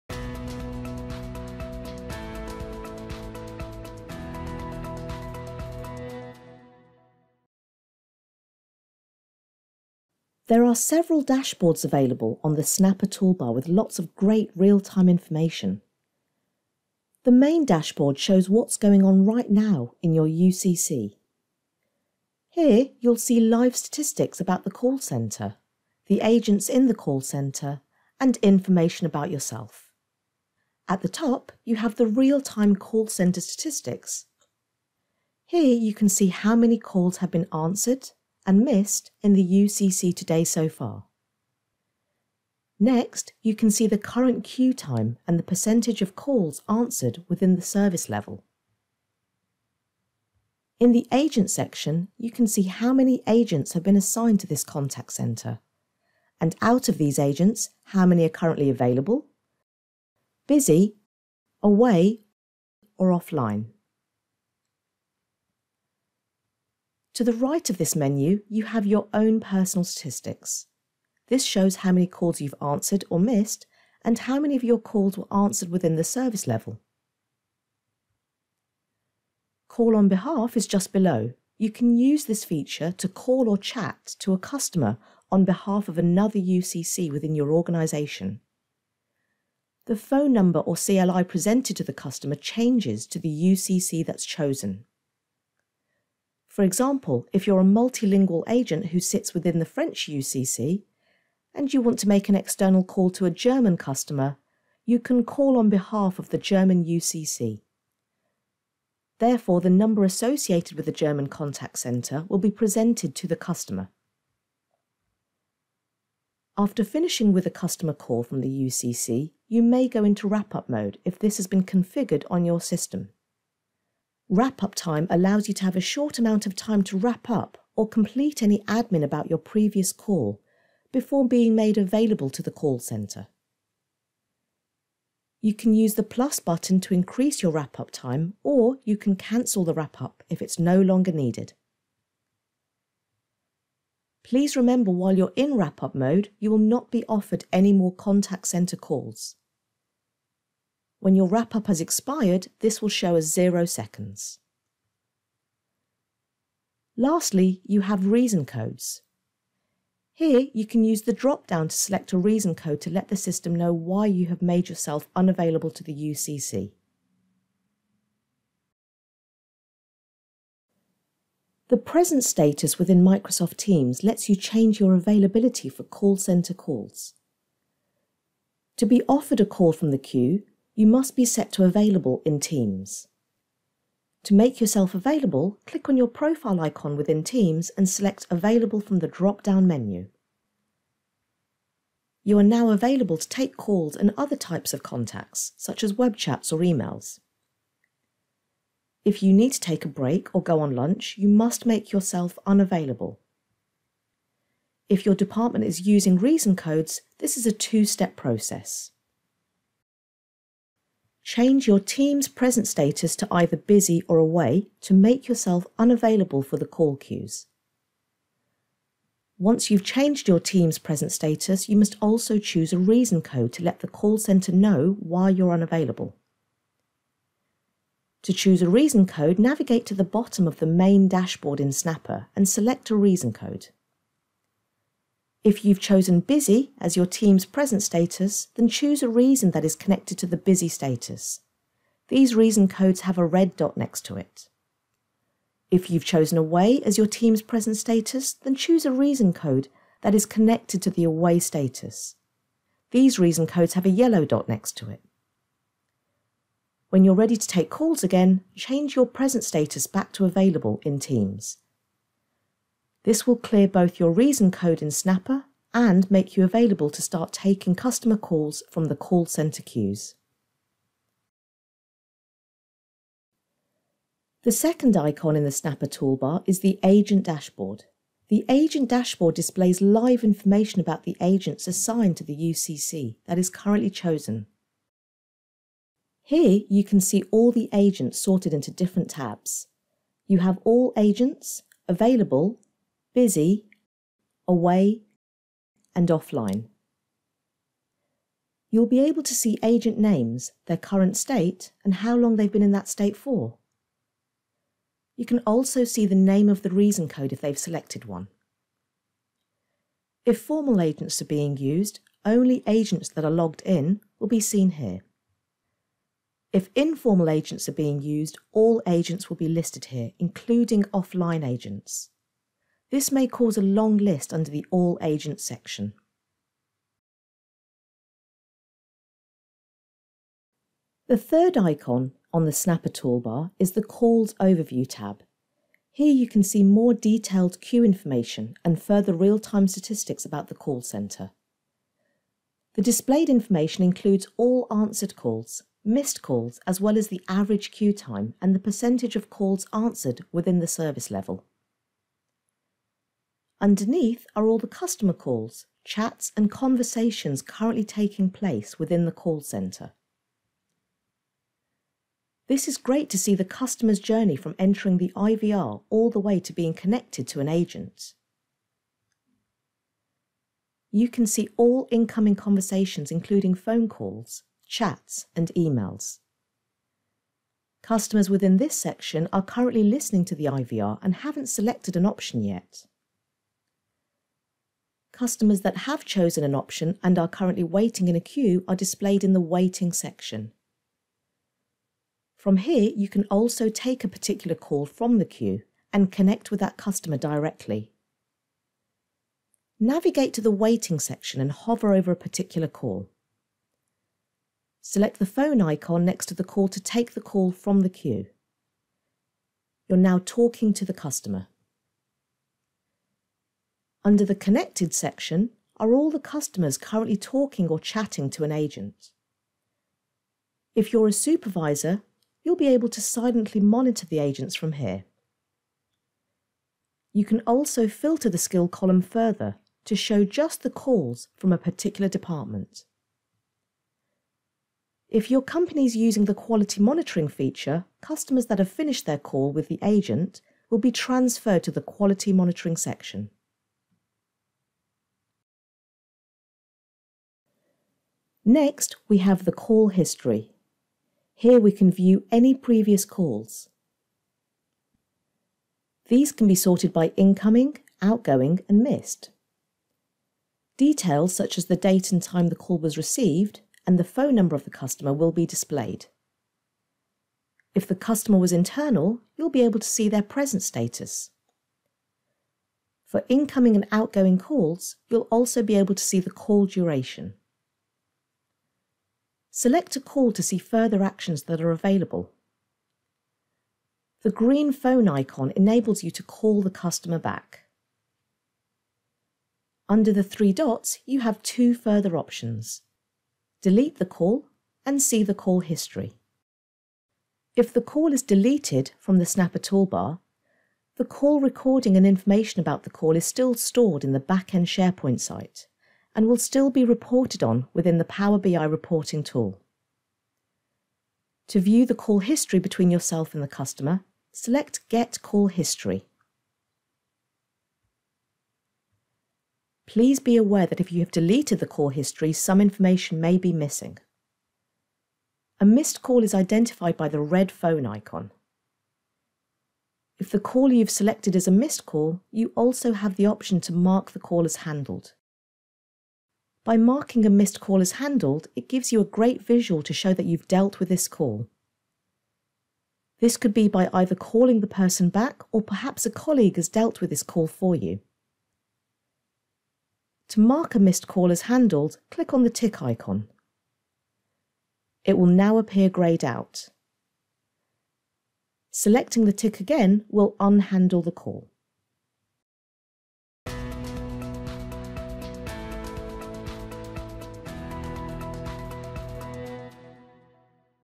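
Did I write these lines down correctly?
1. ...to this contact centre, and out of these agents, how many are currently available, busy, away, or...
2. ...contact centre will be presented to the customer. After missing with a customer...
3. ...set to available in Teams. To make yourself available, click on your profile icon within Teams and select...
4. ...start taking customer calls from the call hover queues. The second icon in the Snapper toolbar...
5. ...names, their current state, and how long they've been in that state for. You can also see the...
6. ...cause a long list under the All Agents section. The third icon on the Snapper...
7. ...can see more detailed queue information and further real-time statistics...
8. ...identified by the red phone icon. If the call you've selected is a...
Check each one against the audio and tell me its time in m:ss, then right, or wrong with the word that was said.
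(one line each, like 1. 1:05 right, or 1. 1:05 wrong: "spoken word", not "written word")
1. 0:54 right
2. 1:51 wrong: "finishing", not "missing"
3. 3:01 right
4. 4:27 wrong: "center", not "hover"
5. 4:59 right
6. 5:23 right
7. 5:36 right
8. 8:46 right.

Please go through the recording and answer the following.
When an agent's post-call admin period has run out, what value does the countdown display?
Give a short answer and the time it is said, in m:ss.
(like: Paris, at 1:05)
0 seconds, at 2:33.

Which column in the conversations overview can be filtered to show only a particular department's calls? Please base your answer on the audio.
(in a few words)
Skill.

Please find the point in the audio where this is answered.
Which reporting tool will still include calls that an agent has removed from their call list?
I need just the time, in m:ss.
8:28.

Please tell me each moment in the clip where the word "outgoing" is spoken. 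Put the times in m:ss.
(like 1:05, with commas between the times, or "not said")
7:38, 7:53.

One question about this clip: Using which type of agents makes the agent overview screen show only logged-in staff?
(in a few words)
Formal agents.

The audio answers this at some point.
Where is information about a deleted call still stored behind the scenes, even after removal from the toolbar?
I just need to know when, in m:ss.
8:24.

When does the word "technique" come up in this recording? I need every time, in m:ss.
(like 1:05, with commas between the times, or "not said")
not said.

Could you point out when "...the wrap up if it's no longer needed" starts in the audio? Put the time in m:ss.
2:19.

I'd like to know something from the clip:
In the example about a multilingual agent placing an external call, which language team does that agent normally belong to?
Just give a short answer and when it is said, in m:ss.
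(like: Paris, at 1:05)
French, at 1:39.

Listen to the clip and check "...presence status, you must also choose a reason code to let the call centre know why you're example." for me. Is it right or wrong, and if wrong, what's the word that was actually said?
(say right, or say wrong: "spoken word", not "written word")
wrong: "unavailable", not "example".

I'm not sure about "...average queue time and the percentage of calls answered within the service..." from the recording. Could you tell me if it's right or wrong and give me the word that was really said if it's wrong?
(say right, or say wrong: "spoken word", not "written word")
right.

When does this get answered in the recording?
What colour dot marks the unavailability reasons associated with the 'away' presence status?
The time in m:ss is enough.
4:13.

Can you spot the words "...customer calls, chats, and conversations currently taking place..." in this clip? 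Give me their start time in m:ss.
5:54.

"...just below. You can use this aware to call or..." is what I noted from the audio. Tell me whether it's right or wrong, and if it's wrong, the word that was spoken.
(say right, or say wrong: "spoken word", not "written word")
wrong: "feature", not "aware".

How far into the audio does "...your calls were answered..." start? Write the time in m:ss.
1:14.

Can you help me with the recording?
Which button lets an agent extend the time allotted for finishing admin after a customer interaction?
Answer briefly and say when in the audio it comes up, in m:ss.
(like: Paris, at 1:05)
plus button, at 2:16.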